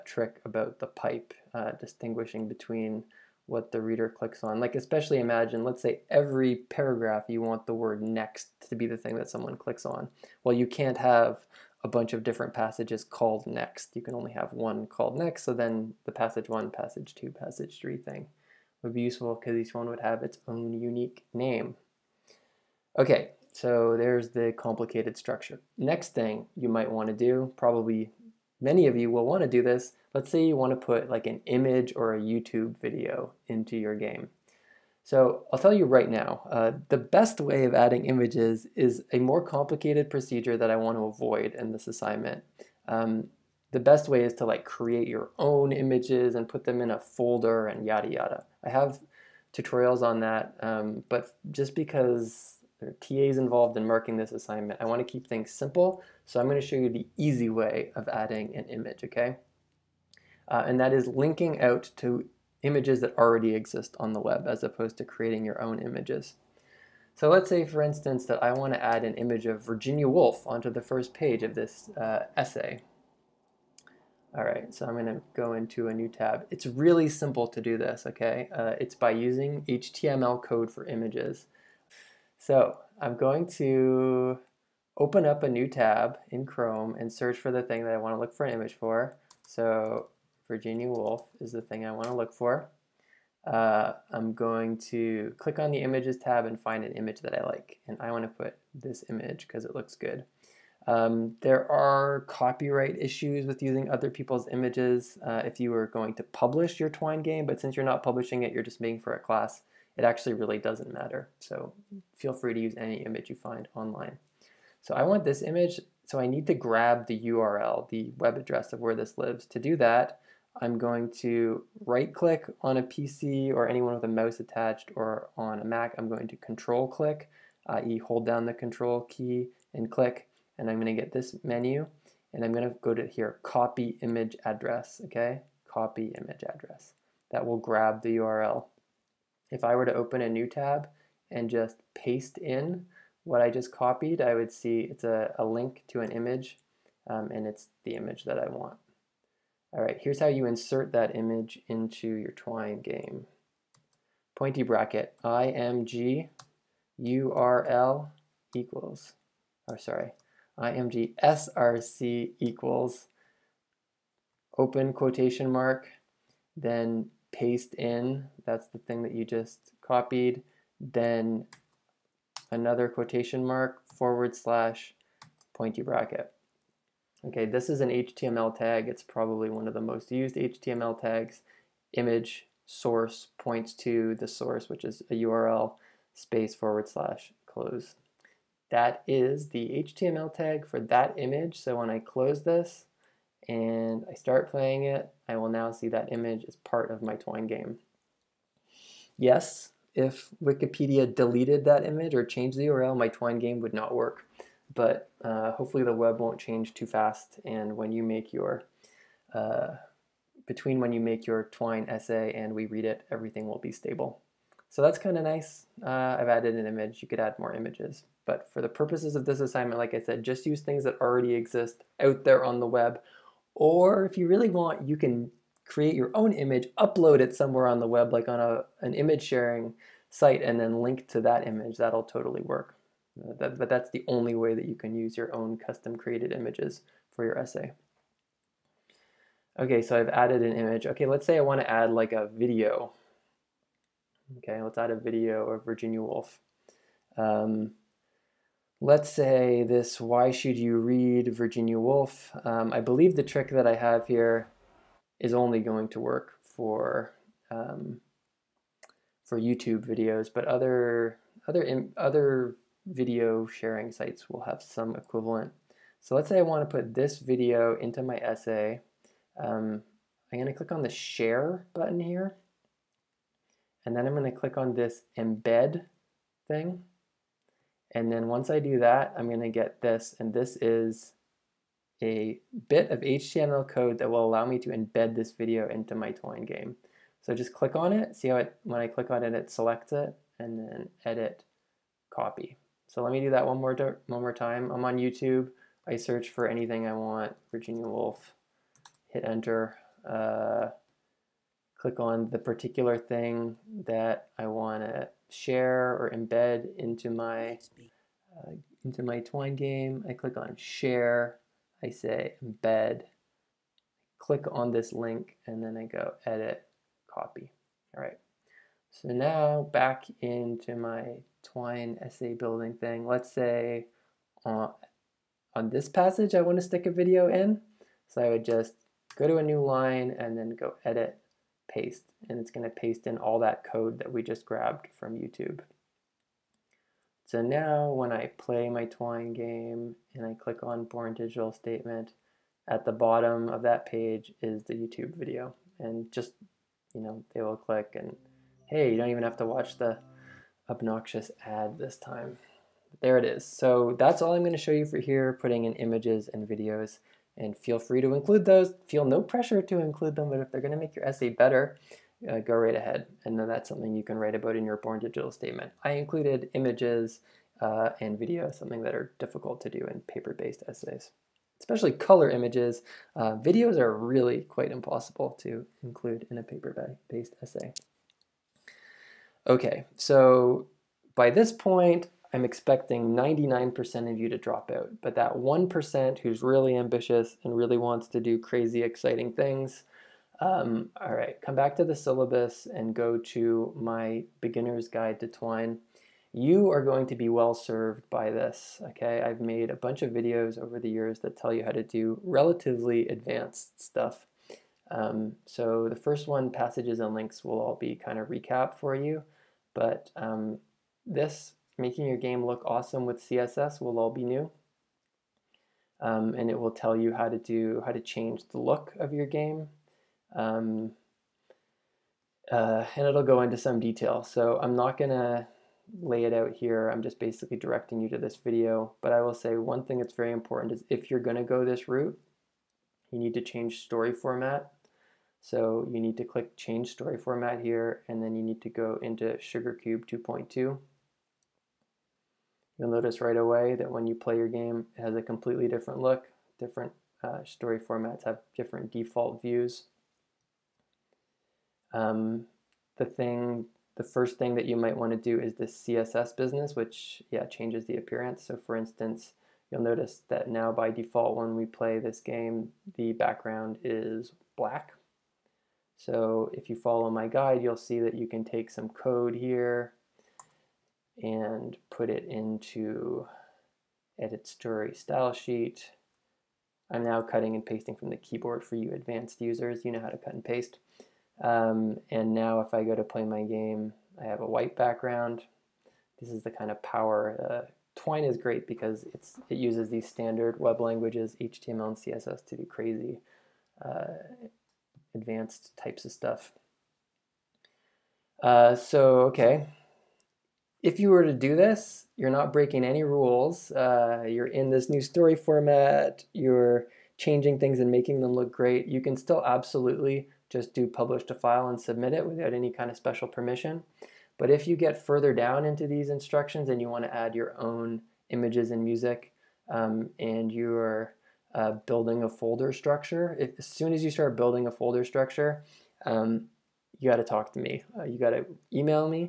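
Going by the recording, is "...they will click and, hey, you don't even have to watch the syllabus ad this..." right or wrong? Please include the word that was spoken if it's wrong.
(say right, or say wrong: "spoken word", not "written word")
wrong: "obnoxious", not "syllabus".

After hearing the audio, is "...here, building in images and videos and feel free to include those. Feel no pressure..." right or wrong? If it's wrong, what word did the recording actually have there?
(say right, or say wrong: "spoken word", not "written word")
wrong: "putting", not "building".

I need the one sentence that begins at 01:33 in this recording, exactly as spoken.
Uh, I'm going to click on the images tab and find an image that I like.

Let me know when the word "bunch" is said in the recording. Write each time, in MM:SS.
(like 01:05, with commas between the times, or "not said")
00:11, 06:39.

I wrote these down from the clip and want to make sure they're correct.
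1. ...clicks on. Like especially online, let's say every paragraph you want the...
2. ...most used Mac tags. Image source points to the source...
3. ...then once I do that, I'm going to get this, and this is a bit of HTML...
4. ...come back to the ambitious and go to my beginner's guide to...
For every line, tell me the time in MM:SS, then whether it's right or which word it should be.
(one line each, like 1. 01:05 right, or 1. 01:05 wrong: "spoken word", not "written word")
1. 00:04 wrong: "imagine", not "online"
2. 02:59 wrong: "HTML", not "Mac"
3. 04:38 right
4. 06:31 wrong: "syllabus", not "ambitious".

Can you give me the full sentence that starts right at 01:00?
Uh, and that is linking out to images that already exist on the web as opposed to creating your own images.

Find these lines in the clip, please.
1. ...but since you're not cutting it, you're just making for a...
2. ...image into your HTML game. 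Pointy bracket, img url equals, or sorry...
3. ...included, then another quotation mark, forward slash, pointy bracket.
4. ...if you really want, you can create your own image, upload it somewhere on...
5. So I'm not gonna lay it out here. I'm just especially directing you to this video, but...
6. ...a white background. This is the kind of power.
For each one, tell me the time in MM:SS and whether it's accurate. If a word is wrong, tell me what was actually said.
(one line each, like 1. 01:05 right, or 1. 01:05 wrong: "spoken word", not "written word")
1. 01:47 wrong: "publishing", not "cutting"
2. 02:31 wrong: "Twine", not "HTML"
3. 02:49 wrong: "copied", not "included"
4. 03:44 right
5. 07:04 wrong: "basically", not "especially"
6. 08:04 right.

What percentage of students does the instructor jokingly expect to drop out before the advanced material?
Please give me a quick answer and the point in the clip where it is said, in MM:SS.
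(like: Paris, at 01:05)
99%, at 06:23.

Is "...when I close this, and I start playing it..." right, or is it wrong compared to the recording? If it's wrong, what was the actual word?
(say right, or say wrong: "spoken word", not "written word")
right.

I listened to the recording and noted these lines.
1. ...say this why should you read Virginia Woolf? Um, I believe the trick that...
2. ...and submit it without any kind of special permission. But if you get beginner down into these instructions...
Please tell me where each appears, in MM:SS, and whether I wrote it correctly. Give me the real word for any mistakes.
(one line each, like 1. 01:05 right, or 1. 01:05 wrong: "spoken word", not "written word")
1. 04:09 right
2. 08:31 wrong: "further", not "beginner".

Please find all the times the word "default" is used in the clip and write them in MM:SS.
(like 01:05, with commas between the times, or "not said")
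07:28, 07:40.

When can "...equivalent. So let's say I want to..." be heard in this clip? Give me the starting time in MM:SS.
04:24.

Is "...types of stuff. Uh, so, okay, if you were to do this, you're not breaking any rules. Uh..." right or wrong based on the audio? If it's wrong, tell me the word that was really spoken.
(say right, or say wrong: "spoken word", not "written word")
right.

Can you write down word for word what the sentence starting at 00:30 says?
Let's say you want to put like an image or a YouTube video into your game.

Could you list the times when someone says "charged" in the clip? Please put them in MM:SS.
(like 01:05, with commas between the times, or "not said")
not said.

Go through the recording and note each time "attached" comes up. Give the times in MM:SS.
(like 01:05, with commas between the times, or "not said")
02:04.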